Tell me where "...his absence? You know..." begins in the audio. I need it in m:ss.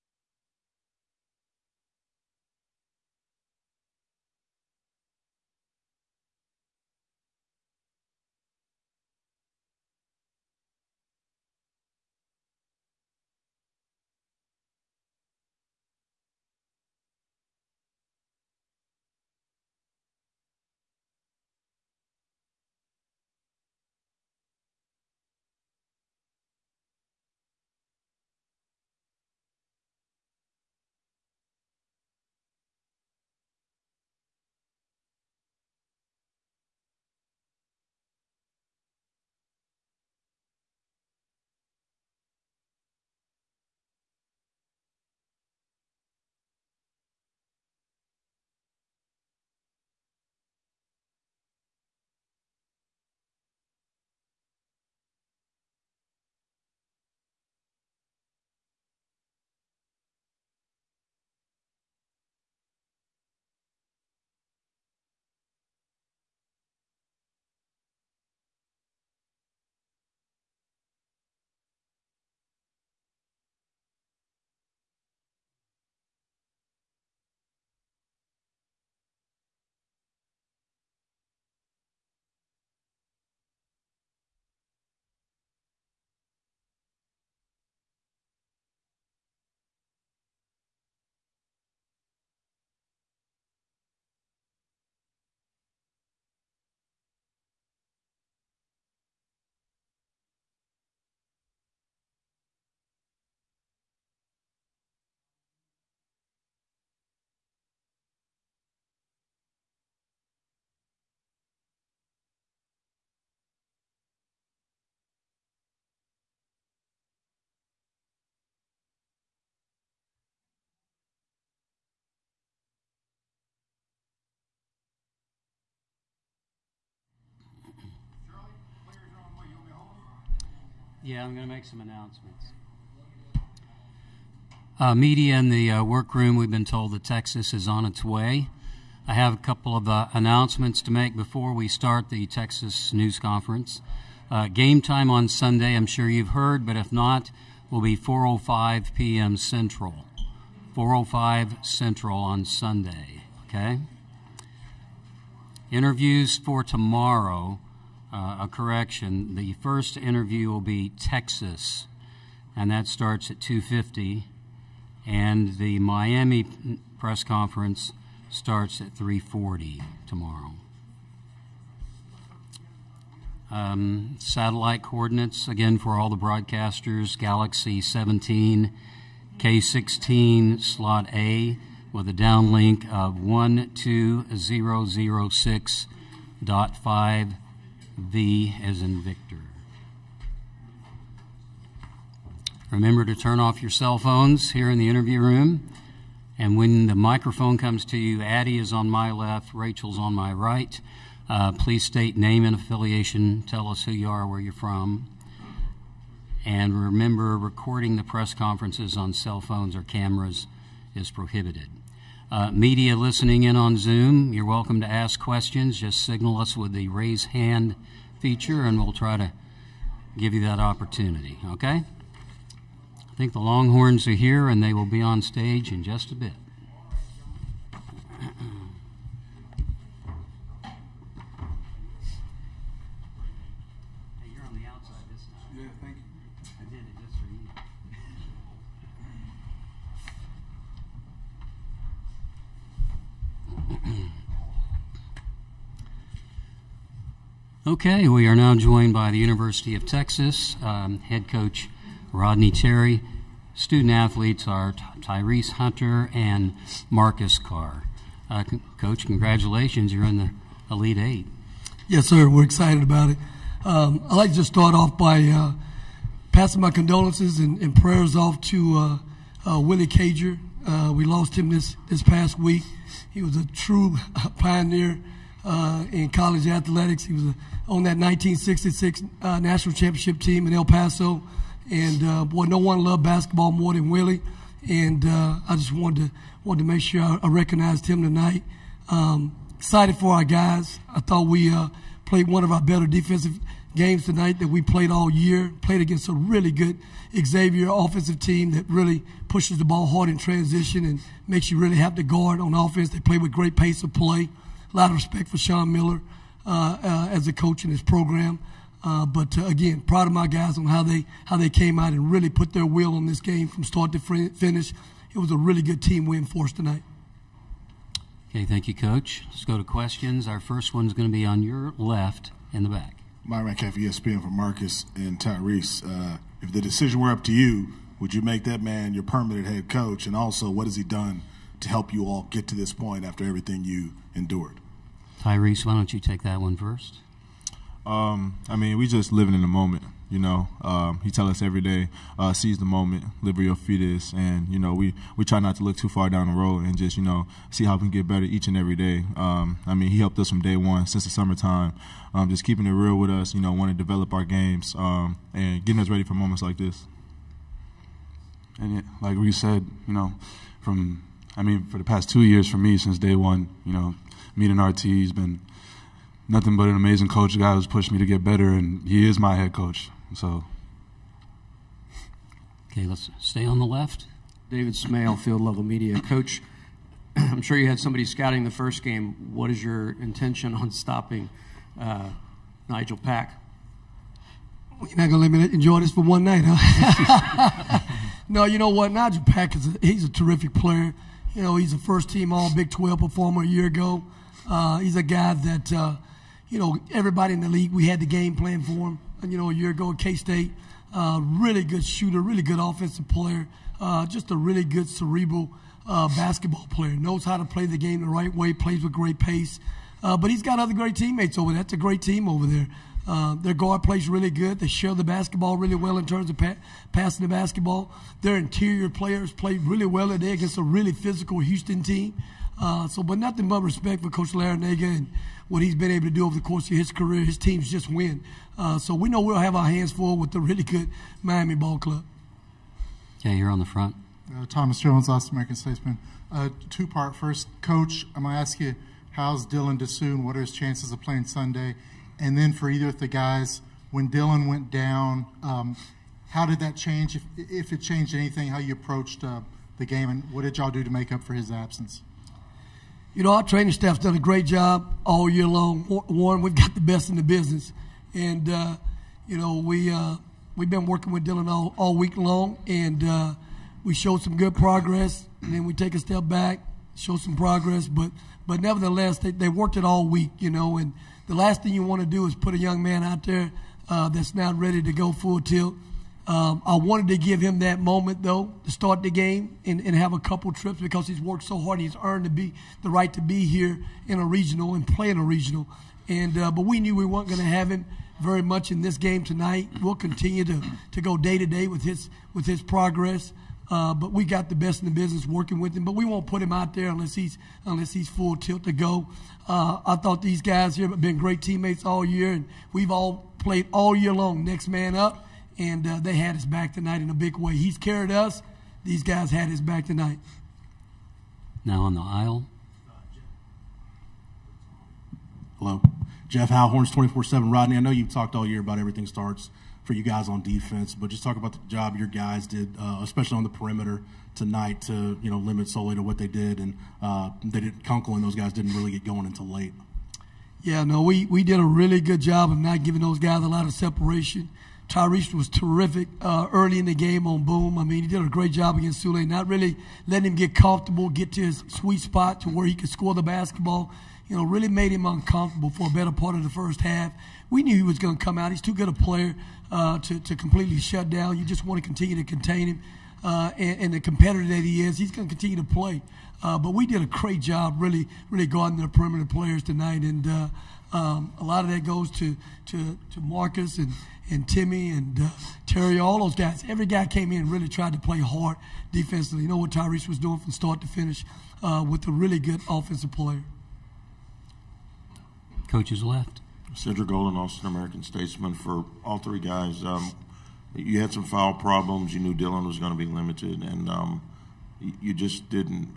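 7:31.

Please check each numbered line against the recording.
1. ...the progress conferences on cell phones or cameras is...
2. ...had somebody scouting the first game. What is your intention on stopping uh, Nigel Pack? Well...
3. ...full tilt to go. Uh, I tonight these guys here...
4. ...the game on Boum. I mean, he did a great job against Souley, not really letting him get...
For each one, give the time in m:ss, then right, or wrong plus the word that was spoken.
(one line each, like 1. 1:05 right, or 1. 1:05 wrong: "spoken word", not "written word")
1. 3:27 wrong: "press", not "progress"
2. 6:17 right
3. 8:18 wrong: "thought", not "tonight"
4. 8:56 right.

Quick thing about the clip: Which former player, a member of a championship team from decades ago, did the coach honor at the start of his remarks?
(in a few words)
Willie Cager.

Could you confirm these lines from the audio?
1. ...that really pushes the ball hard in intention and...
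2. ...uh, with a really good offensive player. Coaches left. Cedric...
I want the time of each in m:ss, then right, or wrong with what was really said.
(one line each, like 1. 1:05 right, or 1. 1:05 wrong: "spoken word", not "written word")
1. 4:58 wrong: "transition", not "intention"
2. 9:31 right.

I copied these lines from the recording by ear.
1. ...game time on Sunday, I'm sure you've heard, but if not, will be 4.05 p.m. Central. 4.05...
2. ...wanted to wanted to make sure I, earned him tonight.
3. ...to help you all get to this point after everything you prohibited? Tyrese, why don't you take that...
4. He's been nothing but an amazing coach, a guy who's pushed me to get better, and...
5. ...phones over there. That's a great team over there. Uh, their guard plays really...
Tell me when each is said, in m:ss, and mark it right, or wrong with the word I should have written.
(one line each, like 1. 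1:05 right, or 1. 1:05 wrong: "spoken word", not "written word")
1. 2:24 right
2. 4:45 wrong: "recognized", not "earned"
3. 5:31 wrong: "endured", not "prohibited"
4. 6:04 right
5. 6:50 wrong: "teammates", not "phones".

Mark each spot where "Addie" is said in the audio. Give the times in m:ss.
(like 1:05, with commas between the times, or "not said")
3:18.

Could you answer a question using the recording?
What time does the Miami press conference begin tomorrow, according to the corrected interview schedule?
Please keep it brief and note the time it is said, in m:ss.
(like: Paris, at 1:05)
3:40, at 2:48.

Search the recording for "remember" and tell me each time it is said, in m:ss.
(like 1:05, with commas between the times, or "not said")
3:12, 3:26.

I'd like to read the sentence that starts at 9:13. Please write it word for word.
Uh, and, and, the competitor that he is, he's going to continue to play.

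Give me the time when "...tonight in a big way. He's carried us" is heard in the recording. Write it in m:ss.
8:26.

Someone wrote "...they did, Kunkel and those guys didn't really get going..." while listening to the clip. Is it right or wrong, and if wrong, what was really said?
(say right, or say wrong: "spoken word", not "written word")
right.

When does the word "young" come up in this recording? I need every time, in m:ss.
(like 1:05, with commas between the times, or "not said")
7:52.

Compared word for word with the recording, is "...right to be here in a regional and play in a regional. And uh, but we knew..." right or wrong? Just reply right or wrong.
right.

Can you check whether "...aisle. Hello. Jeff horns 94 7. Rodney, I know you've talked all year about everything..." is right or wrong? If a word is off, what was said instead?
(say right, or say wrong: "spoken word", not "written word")
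wrong: "24", not "94".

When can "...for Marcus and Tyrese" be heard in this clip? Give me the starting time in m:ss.
5:24.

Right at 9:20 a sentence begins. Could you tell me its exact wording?
And uh, um, a lot of that goes to, to, to Marcus and, and Timmy and uh, Terry, all those guys.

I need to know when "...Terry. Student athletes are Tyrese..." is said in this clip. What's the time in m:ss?
4:12.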